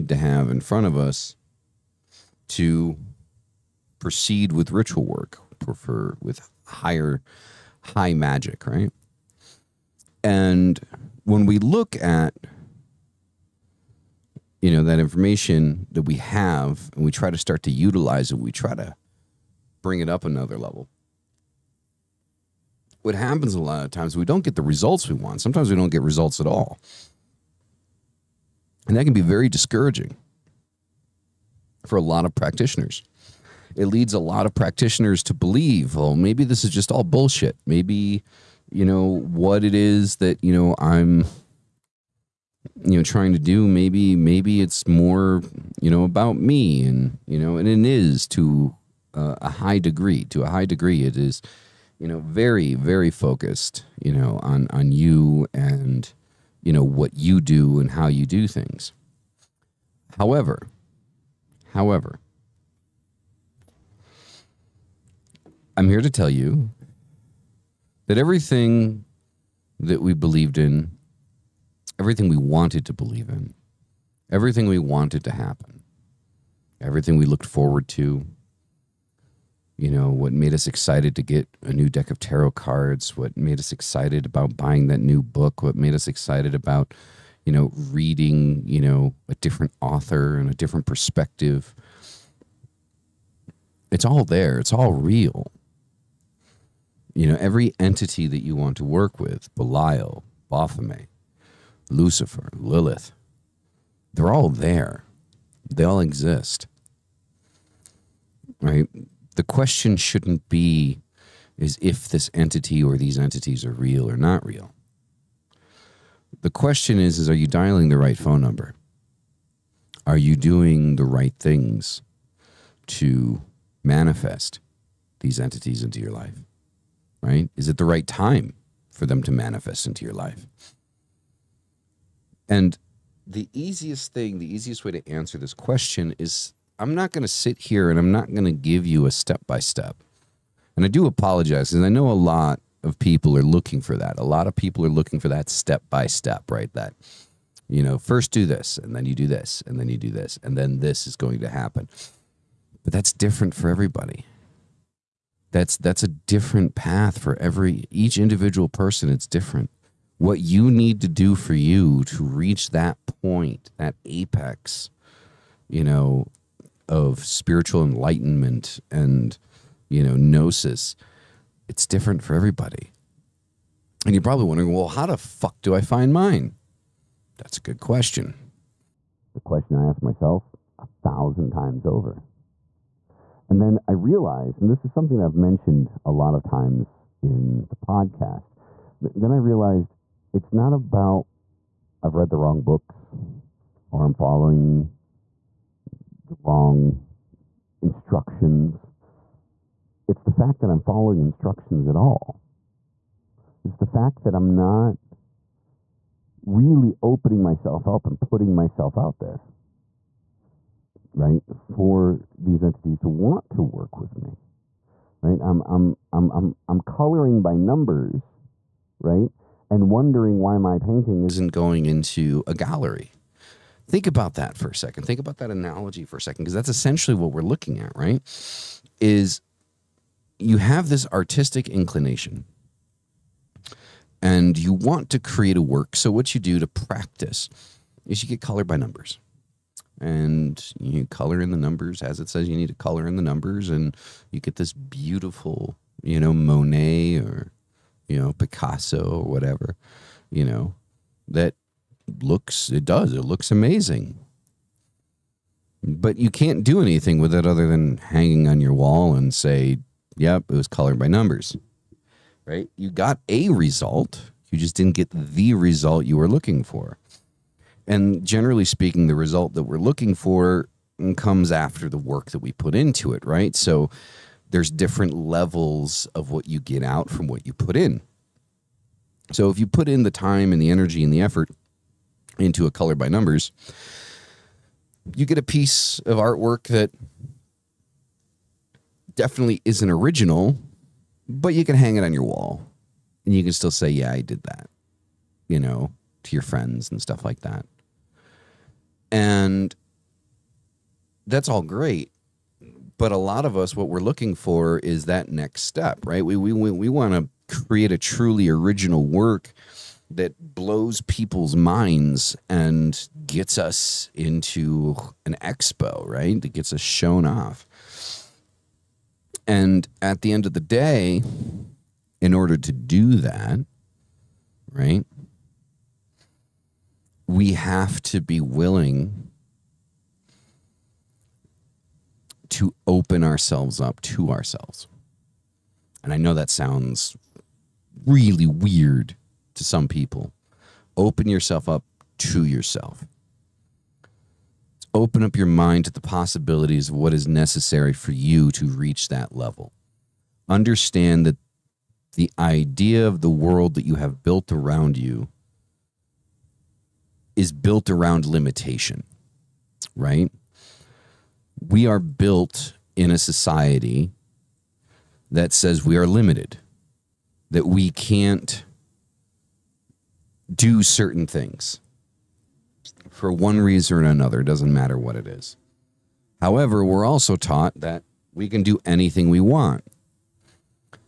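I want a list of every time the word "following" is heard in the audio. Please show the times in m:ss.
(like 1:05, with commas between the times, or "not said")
3:14, 3:20.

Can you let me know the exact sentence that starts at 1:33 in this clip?
It's all there, it's all real.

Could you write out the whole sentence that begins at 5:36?
And I know that sounds really weird to some people.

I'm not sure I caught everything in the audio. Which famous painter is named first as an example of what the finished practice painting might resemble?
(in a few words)
Monet.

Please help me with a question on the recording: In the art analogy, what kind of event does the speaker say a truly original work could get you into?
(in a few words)
an expo.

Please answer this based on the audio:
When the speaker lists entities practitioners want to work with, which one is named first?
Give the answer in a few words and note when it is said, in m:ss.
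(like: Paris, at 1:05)
Belial, at 1:39.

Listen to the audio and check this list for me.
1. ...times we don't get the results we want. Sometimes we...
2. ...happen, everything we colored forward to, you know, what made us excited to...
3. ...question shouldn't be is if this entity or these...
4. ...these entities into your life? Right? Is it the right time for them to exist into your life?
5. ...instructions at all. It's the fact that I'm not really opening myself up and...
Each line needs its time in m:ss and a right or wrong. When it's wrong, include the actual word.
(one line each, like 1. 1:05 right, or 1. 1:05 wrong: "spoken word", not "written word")
1. 0:23 right
2. 1:15 wrong: "looked", not "colored"
3. 1:49 right
4. 2:05 wrong: "manifest", not "exist"
5. 3:21 right.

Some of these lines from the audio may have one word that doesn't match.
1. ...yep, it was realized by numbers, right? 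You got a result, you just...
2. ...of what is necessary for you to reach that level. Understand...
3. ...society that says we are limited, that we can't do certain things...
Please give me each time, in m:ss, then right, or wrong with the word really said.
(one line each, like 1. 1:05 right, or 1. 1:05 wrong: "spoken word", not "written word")
1. 4:20 wrong: "colored", not "realized"
2. 5:46 right
3. 6:03 right.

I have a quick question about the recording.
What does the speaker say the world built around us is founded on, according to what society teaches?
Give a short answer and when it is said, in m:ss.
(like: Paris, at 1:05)
limitation, at 5:58.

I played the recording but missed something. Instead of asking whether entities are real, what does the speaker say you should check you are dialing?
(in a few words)
the right phone number.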